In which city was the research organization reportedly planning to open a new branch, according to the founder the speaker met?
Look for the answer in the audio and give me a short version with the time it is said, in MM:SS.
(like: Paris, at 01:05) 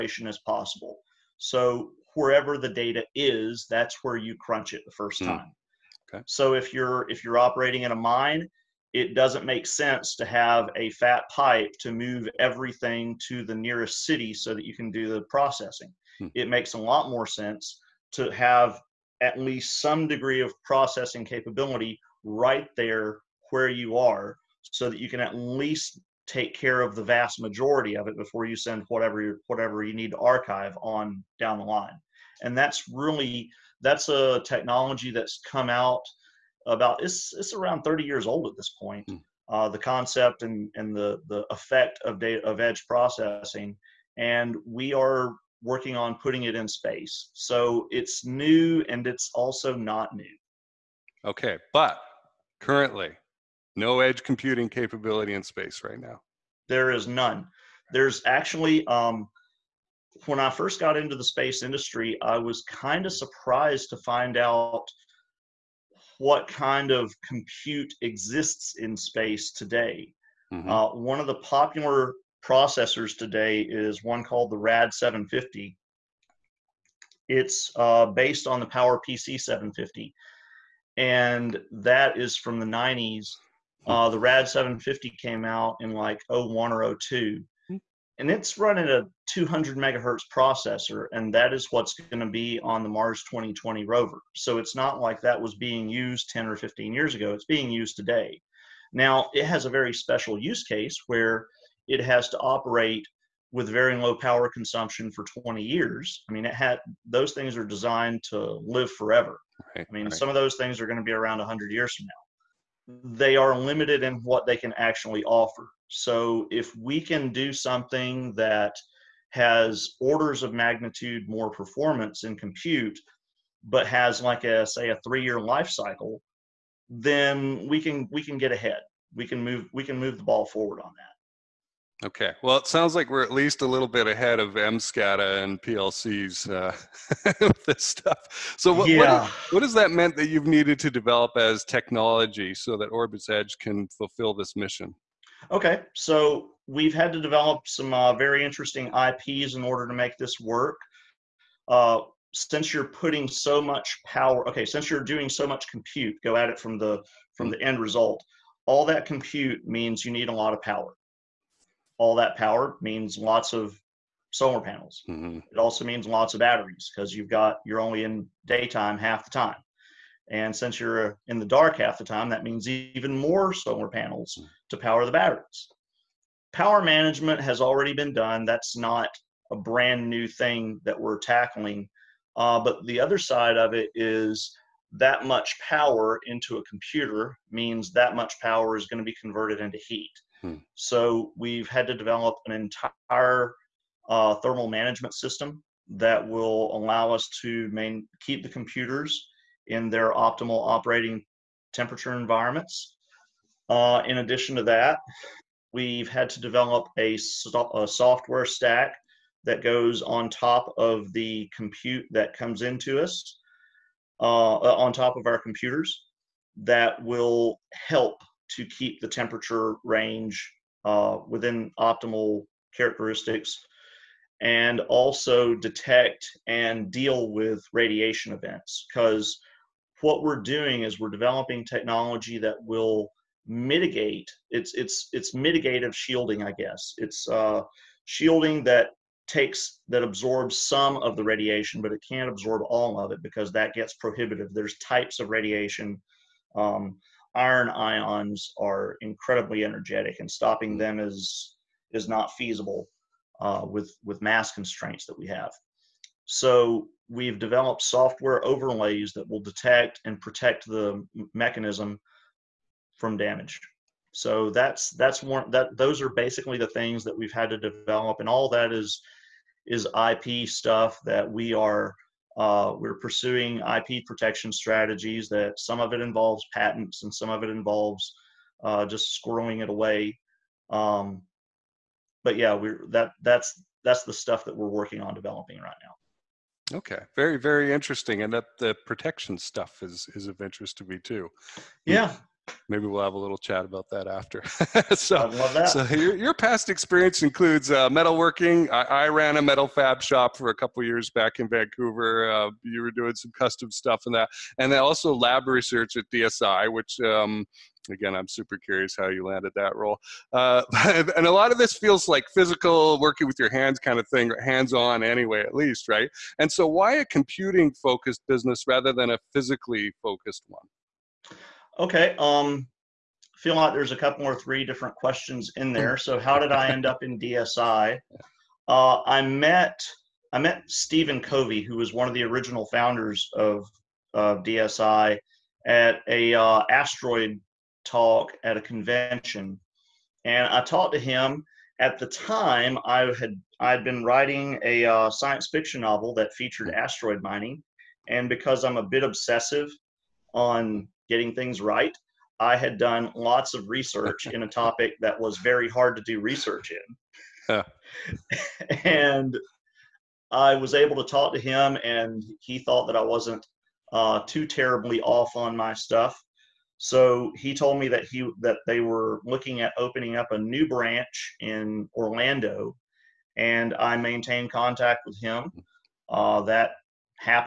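Orlando, at 06:11.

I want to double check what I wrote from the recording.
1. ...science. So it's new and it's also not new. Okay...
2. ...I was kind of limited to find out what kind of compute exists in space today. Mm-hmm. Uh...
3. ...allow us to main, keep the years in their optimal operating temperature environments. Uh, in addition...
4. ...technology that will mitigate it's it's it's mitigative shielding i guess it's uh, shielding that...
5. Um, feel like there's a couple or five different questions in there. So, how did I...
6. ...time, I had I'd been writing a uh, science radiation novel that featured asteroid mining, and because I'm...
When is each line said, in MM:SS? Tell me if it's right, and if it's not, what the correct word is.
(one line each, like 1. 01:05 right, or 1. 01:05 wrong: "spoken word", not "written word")
1. 00:46 wrong: "space", not "science"
2. 01:02 wrong: "surprised", not "limited"
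3. 03:16 wrong: "computers", not "years"
4. 03:51 right
5. 05:22 wrong: "three", not "five"
6. 05:42 wrong: "fiction", not "radiation".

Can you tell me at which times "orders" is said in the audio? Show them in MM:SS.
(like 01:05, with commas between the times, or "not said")
02:00, 02:29.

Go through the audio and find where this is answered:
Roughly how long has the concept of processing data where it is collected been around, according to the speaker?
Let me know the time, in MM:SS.
00:37.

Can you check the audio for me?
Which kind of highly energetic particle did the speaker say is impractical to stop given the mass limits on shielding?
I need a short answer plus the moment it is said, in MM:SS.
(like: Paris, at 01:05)
Iron ions, at 04:07.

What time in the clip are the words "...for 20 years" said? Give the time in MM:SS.
01:45.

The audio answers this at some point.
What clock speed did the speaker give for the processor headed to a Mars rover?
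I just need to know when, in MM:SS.
01:29.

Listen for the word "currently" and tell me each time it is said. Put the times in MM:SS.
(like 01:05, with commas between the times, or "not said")
00:52.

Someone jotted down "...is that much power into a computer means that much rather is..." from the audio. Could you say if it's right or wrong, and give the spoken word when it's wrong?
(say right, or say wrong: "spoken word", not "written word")
wrong: "power", not "rather".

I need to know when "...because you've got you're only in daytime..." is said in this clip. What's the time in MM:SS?
02:46.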